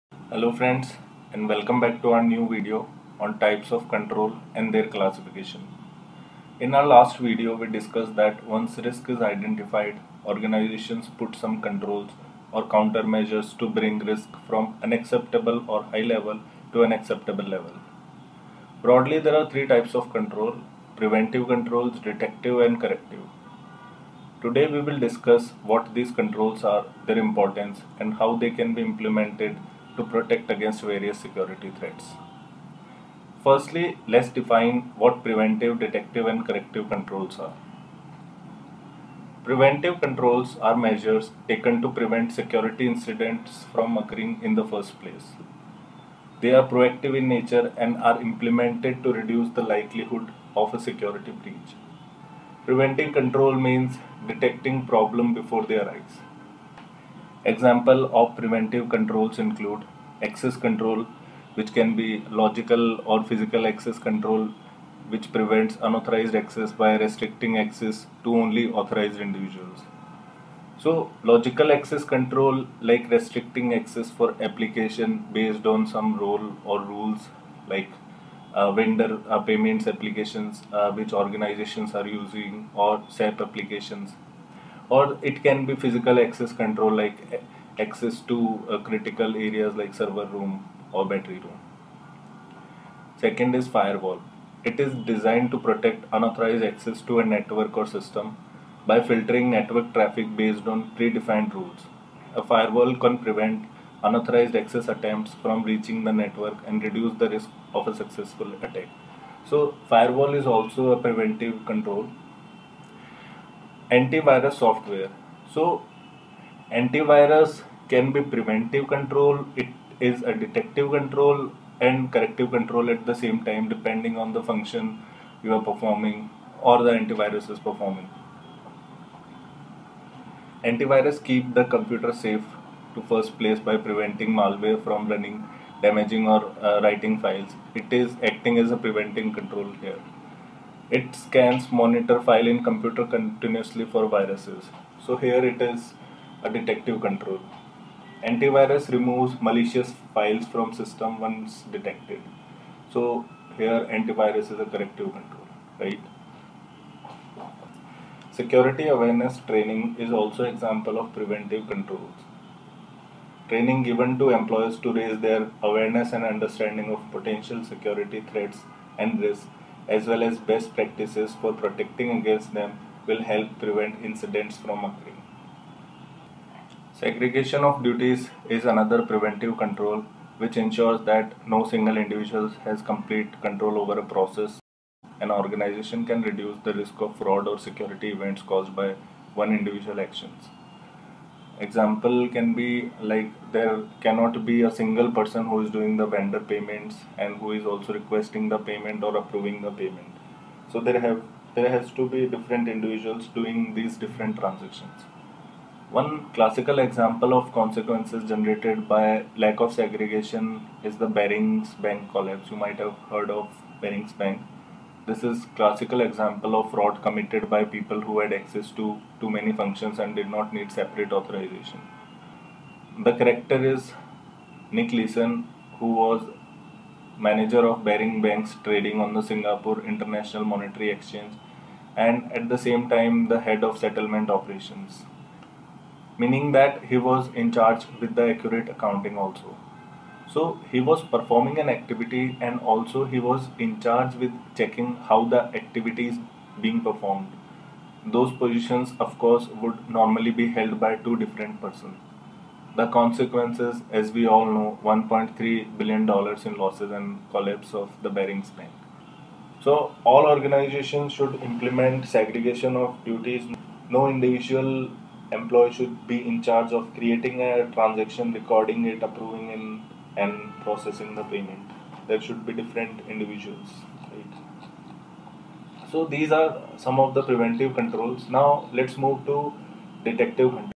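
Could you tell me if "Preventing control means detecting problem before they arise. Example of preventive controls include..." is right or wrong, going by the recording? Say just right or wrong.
right.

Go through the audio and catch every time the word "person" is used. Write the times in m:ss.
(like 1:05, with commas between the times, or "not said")
3:15, 4:11.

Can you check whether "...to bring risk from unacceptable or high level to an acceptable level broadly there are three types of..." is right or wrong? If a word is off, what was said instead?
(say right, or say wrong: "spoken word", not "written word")
right.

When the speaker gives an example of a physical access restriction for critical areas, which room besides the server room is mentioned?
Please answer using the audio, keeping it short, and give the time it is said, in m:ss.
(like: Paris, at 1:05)
battery room, at 1:31.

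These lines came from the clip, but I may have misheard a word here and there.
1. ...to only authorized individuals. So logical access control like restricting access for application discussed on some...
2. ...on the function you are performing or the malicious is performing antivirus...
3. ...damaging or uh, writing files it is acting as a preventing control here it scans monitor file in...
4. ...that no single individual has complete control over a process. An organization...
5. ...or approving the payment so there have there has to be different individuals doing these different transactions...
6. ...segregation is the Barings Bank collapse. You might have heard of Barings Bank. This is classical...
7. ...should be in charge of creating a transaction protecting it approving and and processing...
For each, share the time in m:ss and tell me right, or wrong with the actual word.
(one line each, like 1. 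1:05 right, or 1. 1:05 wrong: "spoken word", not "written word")
1. 1:08 wrong: "based", not "discussed"
2. 2:04 wrong: "antivirus", not "malicious"
3. 2:15 right
4. 3:01 right
5. 3:19 right
6. 3:29 right
7. 4:25 wrong: "recording", not "protecting".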